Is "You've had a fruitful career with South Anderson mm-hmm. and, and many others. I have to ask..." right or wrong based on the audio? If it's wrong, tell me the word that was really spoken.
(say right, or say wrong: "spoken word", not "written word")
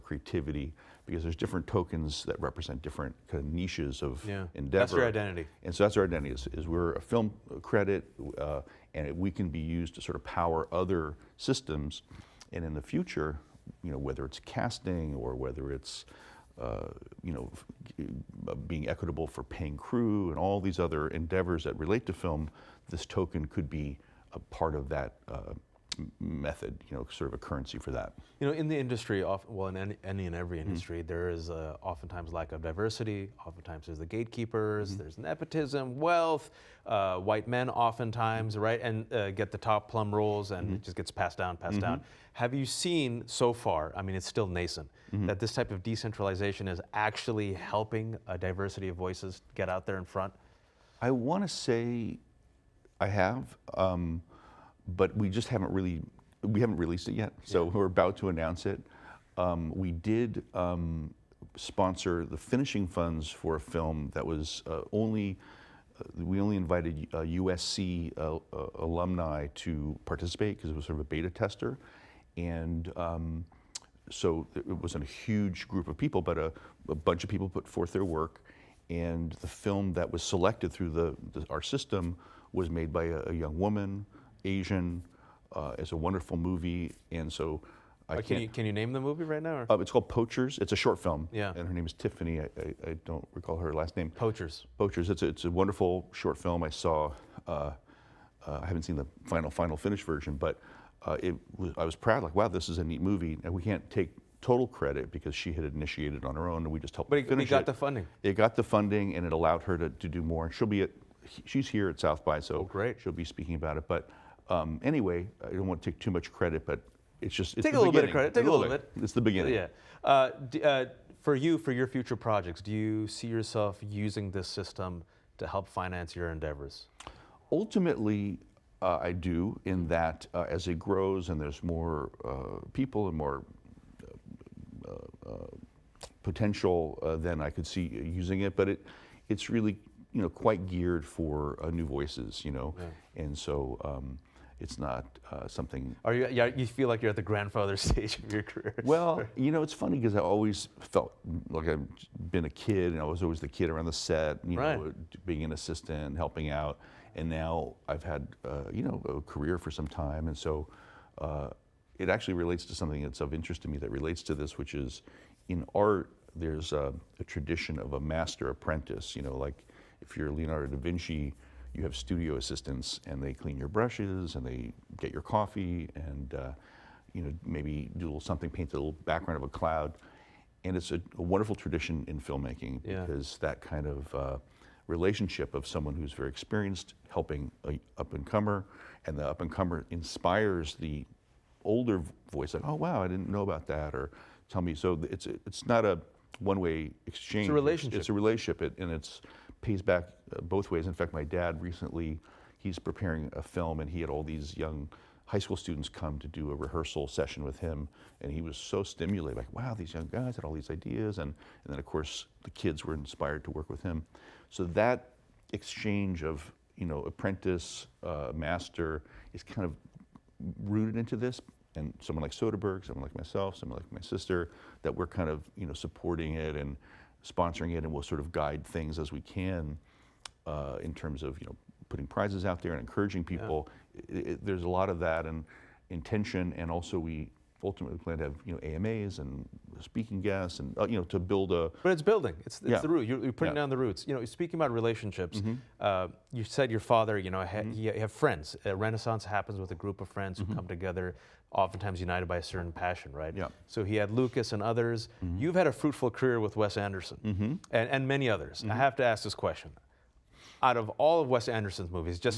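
wrong: "Wes", not "South".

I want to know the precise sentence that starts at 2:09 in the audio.
In that, uh, as it grows and there's more uh, people and more uh, potential, then I could see using it.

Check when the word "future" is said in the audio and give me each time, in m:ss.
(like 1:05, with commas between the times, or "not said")
0:12, 2:01.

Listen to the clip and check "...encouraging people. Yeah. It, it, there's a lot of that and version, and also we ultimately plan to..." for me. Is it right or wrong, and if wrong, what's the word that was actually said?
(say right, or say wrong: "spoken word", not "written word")
wrong: "intention", not "version".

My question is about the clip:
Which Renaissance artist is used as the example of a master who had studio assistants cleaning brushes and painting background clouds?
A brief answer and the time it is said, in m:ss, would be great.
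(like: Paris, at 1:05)
Leonardo da Vinci, at 2:50.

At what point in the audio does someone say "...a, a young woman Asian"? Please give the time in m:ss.
1:23.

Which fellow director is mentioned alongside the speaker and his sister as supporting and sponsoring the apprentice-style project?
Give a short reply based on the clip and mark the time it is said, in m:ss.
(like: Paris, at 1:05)
Soderbergh, at 3:42.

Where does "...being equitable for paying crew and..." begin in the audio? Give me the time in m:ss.
0:18.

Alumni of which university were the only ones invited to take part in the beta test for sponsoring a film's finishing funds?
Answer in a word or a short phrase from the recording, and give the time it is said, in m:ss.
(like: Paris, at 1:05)
USC, at 1:07.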